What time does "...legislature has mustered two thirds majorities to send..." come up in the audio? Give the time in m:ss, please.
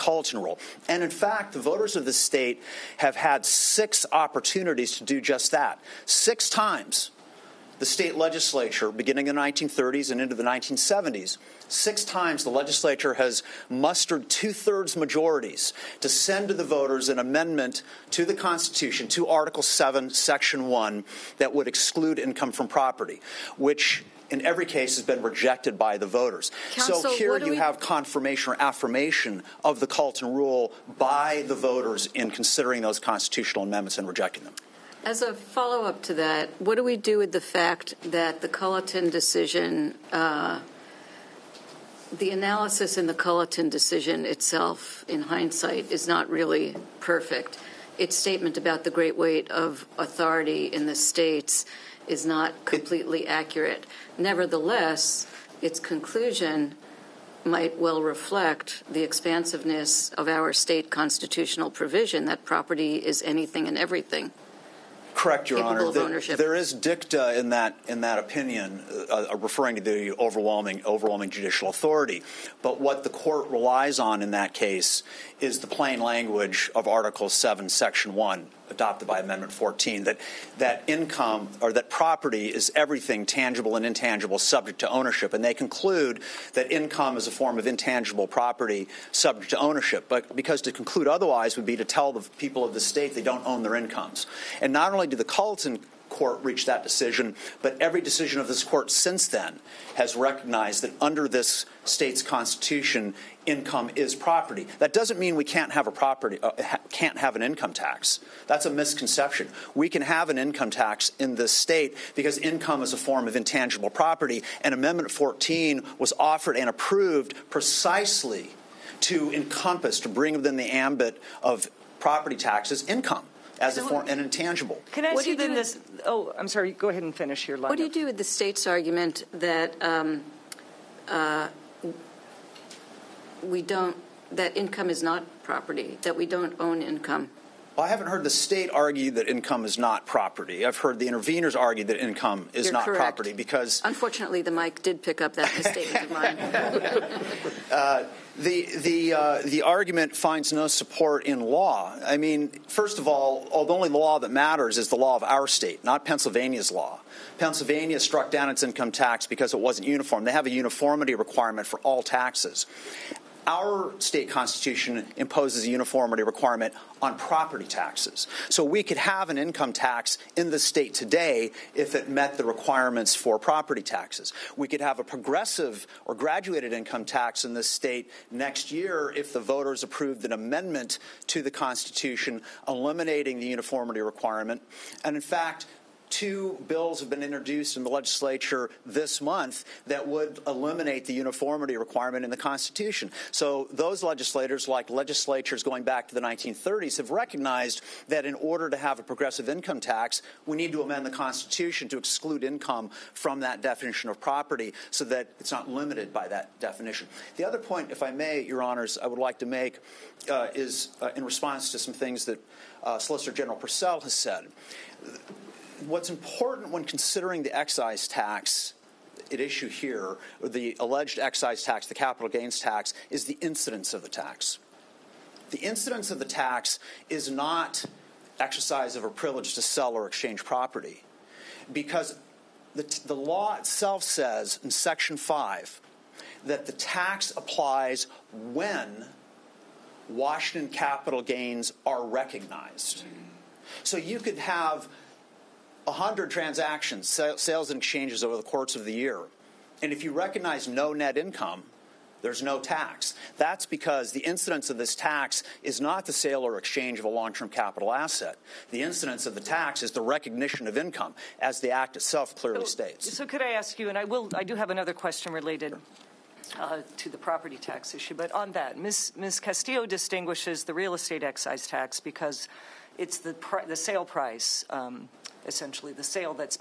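0:12.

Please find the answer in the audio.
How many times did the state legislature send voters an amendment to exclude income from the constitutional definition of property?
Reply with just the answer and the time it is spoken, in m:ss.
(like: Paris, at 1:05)
6, at 0:03.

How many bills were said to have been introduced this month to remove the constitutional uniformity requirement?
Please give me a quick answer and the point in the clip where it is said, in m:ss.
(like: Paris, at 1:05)
2, at 3:06.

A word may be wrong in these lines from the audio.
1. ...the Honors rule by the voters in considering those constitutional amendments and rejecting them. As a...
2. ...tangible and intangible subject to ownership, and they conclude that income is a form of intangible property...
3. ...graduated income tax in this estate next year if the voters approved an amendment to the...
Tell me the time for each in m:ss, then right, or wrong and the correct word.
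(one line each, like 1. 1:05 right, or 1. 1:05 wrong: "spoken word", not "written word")
1. 0:29 wrong: "Culliton", not "Honors"
2. 1:23 right
3. 2:56 wrong: "state", not "estate".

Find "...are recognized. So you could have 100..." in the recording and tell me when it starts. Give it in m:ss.
4:01.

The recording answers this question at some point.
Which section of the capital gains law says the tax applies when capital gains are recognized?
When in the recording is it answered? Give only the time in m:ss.
3:54.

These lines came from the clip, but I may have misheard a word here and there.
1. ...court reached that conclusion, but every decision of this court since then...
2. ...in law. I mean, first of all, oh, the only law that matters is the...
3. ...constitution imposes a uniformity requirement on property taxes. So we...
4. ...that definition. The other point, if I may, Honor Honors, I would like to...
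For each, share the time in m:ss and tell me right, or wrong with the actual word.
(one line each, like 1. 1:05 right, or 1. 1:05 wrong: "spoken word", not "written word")
1. 1:36 wrong: "decision", not "conclusion"
2. 2:31 right
3. 2:44 right
4. 3:26 wrong: "Your", not "Honor".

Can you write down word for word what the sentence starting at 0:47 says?
Its statement about the great weight of authority in the states is not completely accurate.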